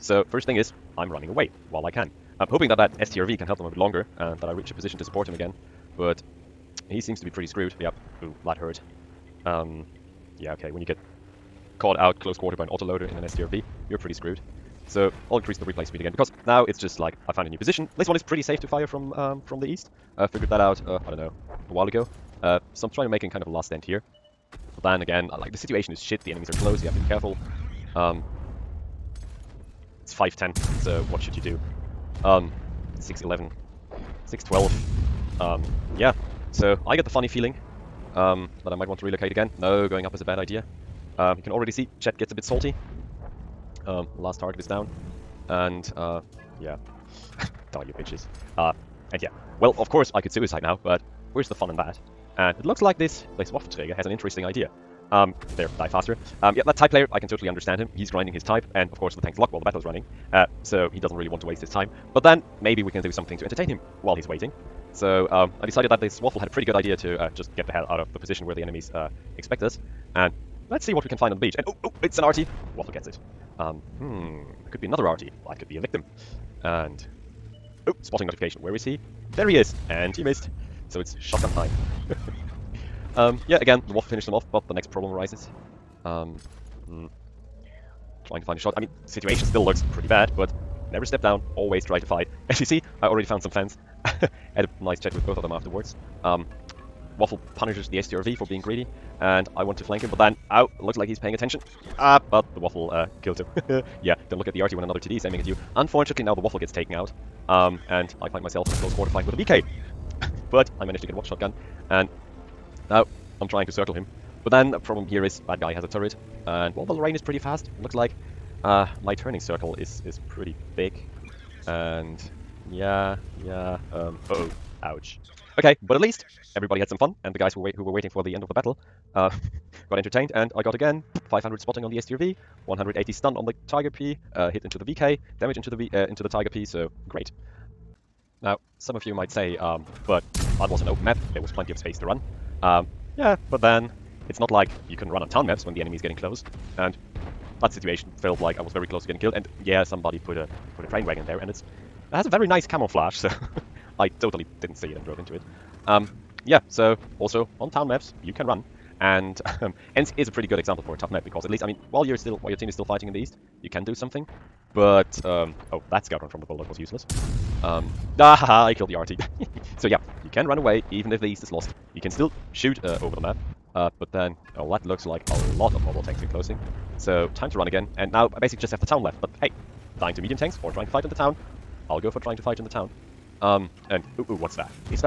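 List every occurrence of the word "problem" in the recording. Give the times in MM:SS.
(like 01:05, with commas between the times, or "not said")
01:24, 01:54.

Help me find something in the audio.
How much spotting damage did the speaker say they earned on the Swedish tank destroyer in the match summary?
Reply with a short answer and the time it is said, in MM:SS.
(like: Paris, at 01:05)
500, at 02:11.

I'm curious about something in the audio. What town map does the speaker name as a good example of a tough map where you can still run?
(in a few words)
Ensk.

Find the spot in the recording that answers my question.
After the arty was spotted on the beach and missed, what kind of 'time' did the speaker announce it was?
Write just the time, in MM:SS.
01:21.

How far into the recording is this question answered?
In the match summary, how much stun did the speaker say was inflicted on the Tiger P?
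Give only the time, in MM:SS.
02:12.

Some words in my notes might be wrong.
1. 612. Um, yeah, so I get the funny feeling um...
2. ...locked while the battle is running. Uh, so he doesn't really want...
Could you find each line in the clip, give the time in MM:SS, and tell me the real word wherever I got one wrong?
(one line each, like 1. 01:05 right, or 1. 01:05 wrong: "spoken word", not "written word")
1. 00:34 right
2. 00:59 right.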